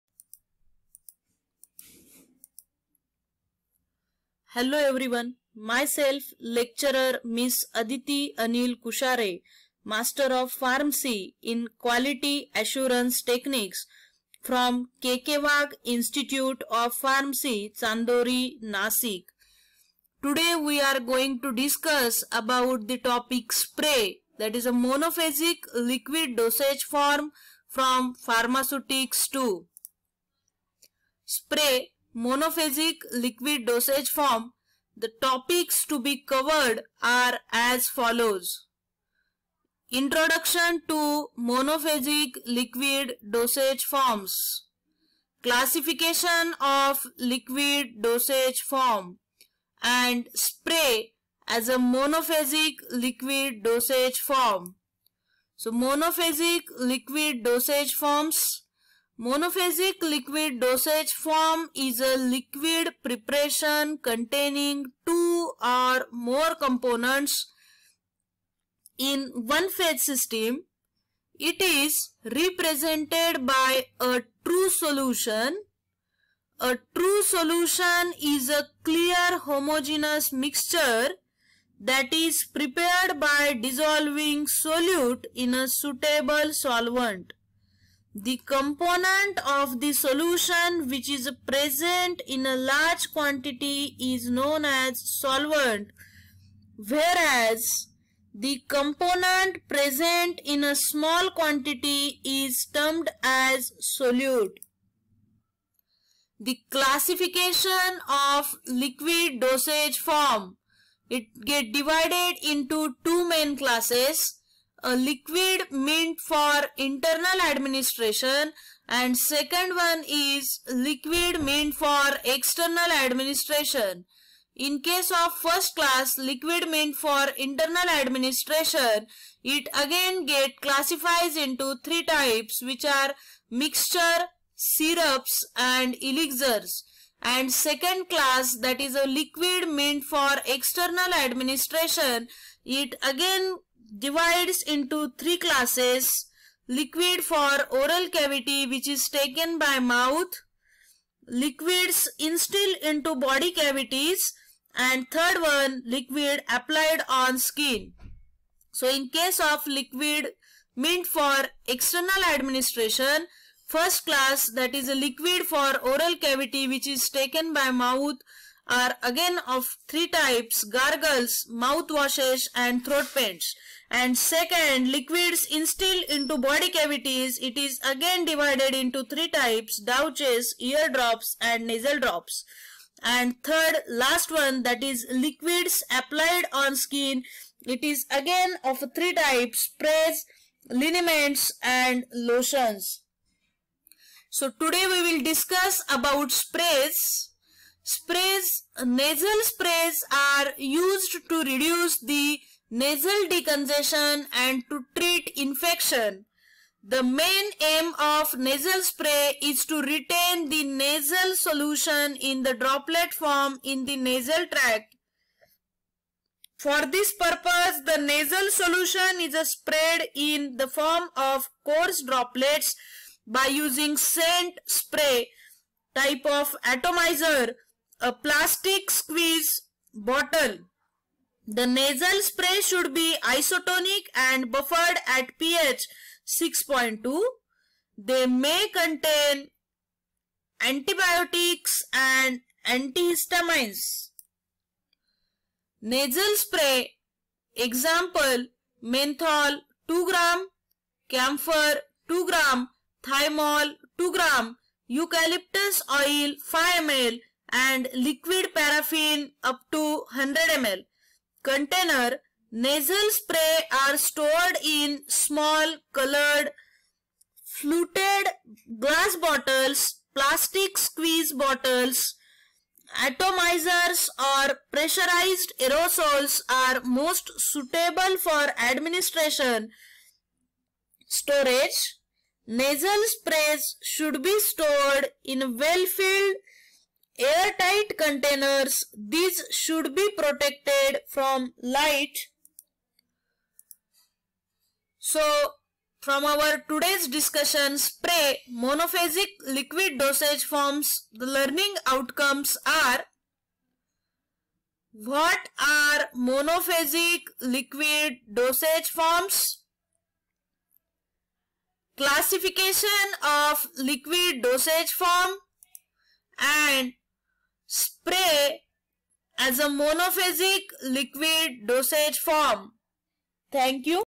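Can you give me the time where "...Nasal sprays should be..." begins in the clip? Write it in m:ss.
4:42.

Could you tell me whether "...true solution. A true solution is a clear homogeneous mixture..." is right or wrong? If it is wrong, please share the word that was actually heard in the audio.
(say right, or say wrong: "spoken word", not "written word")
right.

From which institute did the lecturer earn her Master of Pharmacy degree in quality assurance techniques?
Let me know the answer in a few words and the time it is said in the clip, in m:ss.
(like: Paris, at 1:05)
KK Wagh Institute of Pharmacy, at 0:15.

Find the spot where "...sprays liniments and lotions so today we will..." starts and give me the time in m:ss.
3:09.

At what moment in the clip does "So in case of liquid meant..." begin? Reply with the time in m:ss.
2:38.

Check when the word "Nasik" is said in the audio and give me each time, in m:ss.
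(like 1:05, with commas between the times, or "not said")
0:18.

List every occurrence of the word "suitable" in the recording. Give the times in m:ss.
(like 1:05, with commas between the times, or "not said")
1:25, 4:37.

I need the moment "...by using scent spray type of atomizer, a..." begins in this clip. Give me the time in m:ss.
3:43.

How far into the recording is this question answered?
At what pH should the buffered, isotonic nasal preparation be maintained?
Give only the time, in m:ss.
3:56.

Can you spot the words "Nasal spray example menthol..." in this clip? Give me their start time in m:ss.
4:05.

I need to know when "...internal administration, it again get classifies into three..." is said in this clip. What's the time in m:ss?
2:07.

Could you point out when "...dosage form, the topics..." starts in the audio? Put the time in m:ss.
0:33.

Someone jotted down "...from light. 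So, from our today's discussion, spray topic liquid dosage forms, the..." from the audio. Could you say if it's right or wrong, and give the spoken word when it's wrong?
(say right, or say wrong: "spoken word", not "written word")
wrong: "monophasic", not "topic".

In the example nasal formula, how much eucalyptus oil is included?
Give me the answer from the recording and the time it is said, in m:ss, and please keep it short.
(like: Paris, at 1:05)
5 ml, at 4:16.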